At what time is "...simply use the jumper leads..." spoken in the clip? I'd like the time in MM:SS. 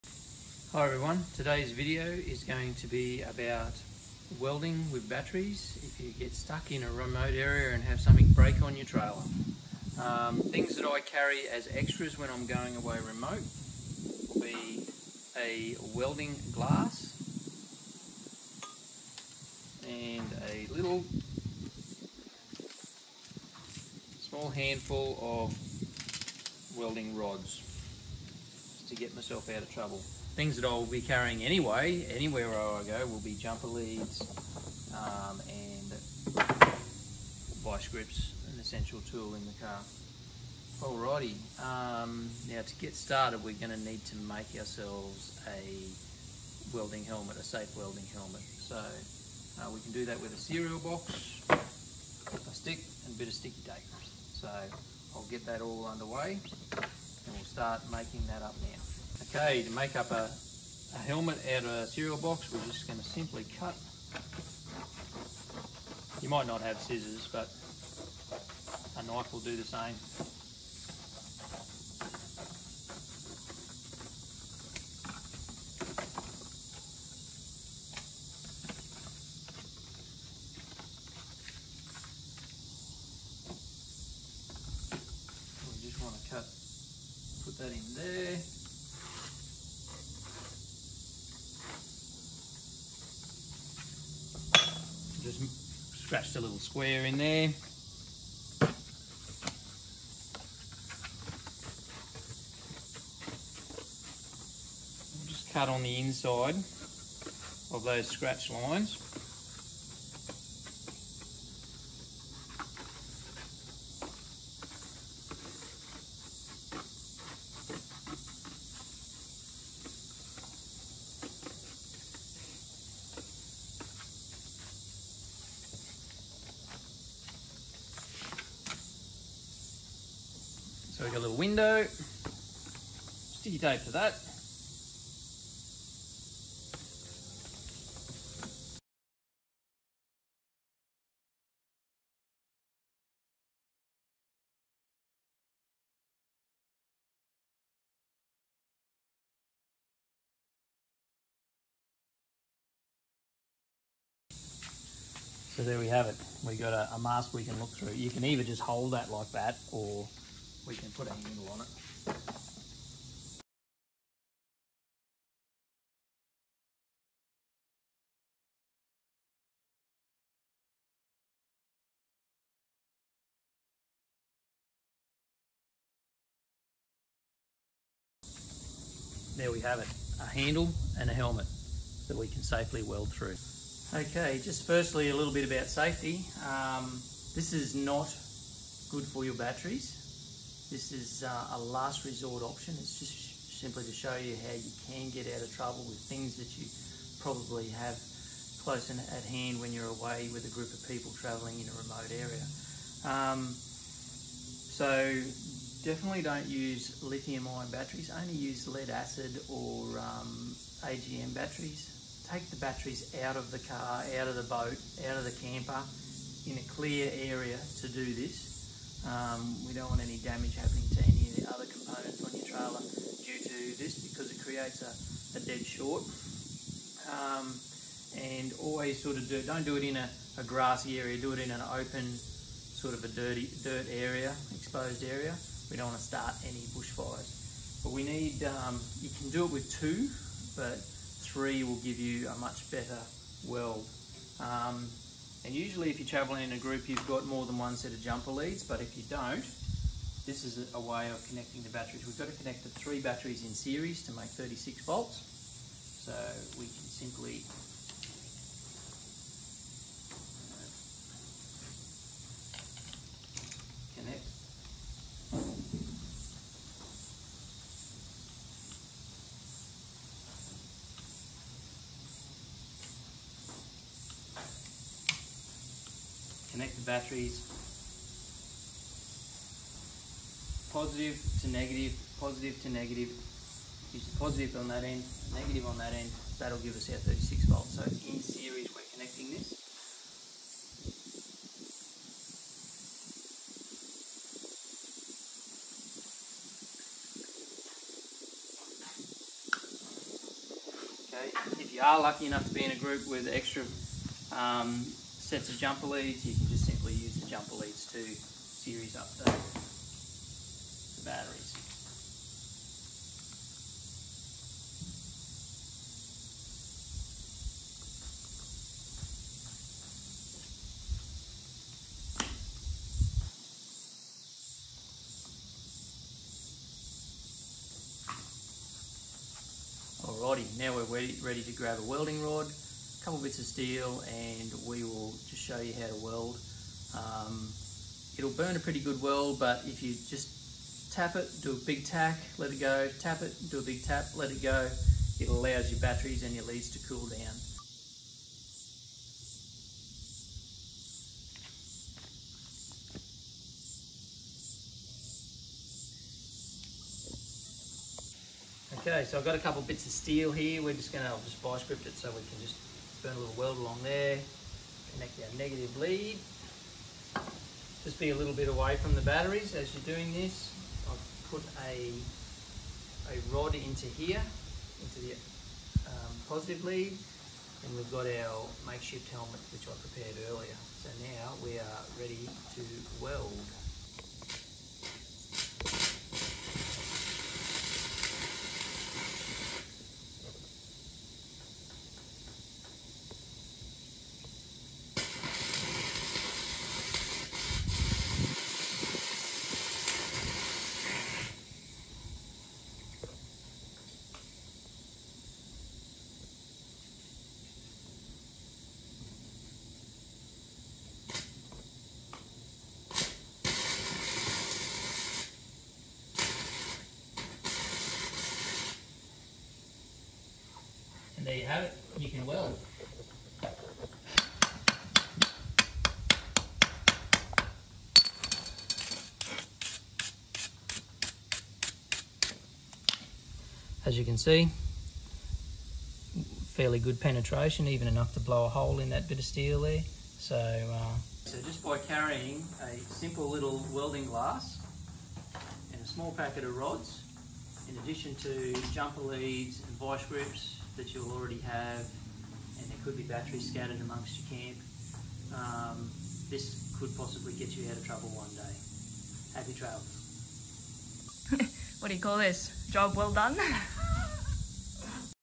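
05:06.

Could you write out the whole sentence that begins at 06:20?
So now we are ready to weld.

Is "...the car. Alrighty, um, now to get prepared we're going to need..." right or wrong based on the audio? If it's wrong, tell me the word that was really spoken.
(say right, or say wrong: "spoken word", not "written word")
wrong: "started", not "prepared".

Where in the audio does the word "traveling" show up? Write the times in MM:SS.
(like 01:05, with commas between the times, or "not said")
03:21, 04:06.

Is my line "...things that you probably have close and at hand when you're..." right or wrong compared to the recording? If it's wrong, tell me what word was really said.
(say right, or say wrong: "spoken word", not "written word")
right.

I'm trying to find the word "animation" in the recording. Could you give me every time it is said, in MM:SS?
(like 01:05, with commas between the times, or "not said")
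not said.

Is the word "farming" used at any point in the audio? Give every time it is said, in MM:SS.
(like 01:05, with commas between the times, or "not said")
not said.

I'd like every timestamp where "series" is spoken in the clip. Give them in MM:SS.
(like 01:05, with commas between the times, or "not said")
04:13, 04:48, 05:08.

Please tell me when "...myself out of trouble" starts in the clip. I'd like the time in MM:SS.
00:29.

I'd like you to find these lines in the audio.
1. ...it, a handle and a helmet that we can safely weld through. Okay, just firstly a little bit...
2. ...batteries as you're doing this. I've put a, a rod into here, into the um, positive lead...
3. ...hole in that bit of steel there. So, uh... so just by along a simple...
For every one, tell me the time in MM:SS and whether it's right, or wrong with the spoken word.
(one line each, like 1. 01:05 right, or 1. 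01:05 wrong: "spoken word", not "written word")
1. 02:59 right
2. 06:09 right
3. 07:18 wrong: "carrying", not "along".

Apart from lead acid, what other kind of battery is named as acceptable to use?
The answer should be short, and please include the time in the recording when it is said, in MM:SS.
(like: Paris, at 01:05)
AGM, at 03:30.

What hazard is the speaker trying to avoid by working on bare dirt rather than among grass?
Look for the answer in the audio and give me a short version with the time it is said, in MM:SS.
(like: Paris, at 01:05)
bushfires, at 03:56.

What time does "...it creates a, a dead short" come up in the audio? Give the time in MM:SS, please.
03:44.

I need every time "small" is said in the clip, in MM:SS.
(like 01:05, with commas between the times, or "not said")
00:24, 07:25.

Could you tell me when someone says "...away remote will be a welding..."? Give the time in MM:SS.
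00:12.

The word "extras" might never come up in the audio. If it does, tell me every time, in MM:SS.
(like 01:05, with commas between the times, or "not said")
00:11, 05:03.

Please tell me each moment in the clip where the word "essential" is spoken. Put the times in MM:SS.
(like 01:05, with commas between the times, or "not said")
00:38.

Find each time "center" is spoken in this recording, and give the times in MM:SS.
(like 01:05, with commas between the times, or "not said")
not said.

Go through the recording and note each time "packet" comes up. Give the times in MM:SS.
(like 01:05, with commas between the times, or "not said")
07:26.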